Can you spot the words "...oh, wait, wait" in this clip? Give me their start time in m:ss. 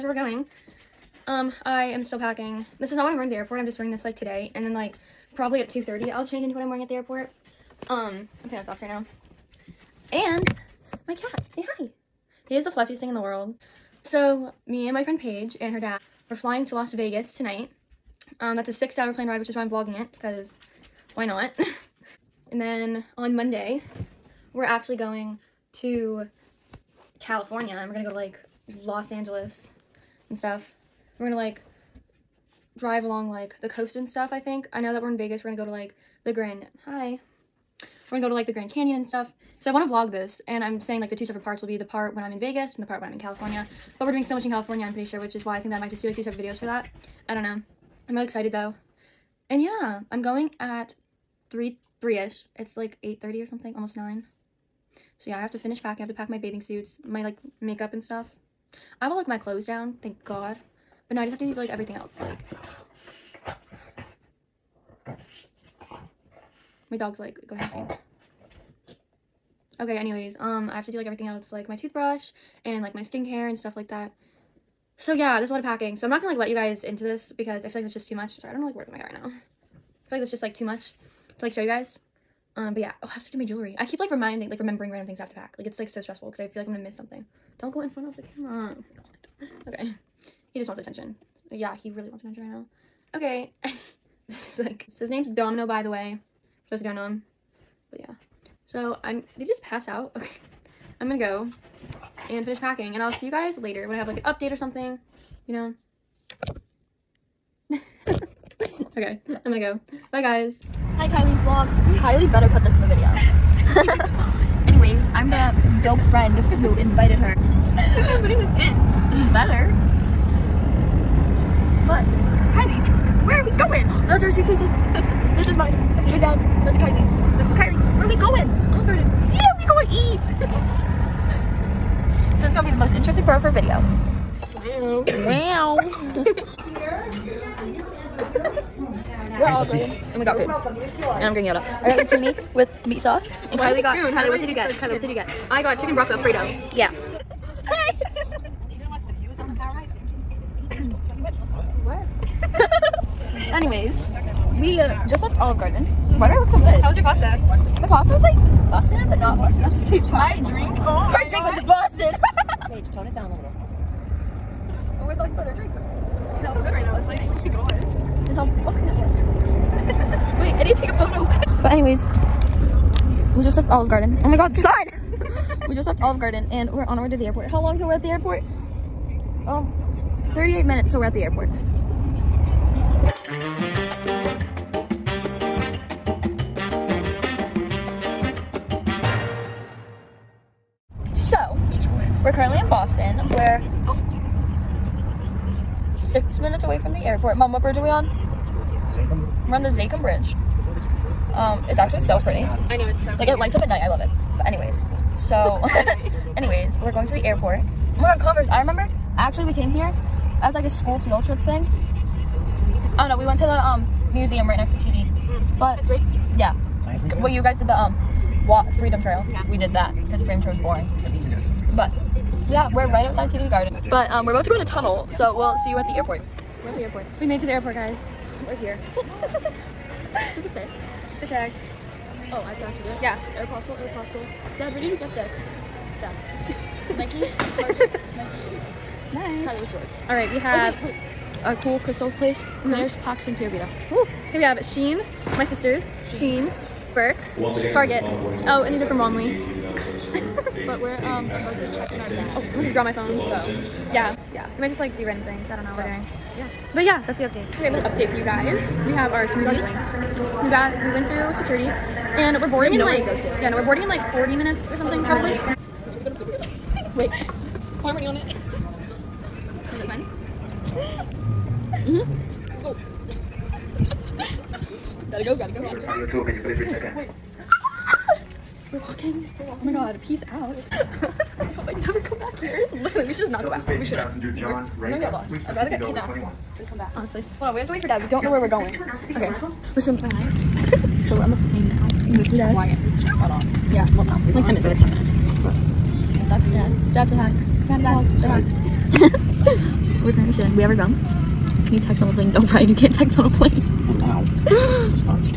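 4:00.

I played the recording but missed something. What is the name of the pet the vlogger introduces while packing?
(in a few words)
Domino.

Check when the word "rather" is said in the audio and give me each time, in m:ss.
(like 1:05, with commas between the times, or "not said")
4:45.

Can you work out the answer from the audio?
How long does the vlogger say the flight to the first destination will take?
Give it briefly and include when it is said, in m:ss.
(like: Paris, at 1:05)
6 hours, at 0:18.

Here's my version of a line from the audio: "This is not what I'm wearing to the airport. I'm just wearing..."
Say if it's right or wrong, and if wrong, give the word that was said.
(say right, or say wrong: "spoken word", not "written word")
right.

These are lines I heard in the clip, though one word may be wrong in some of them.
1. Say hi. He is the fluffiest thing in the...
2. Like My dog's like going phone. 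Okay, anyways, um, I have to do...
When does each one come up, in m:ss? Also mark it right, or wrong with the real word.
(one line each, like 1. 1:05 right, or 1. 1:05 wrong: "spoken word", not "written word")
1. 0:11 right
2. 1:02 wrong: "insane", not "phone".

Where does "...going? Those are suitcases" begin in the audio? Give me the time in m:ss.
2:03.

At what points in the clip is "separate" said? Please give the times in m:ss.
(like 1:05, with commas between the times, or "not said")
0:41, 0:46.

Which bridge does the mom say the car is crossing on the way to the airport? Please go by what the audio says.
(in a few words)
Zakim Bridge.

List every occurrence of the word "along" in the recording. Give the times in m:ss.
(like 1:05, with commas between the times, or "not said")
0:33.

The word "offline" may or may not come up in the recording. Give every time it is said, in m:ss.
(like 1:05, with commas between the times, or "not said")
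not said.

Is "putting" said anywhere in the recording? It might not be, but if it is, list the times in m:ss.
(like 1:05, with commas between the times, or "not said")
0:08, 1:58.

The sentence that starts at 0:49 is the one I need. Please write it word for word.
And yeah, I'm going at 3 3ish.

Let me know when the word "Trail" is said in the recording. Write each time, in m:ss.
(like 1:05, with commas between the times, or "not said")
3:39.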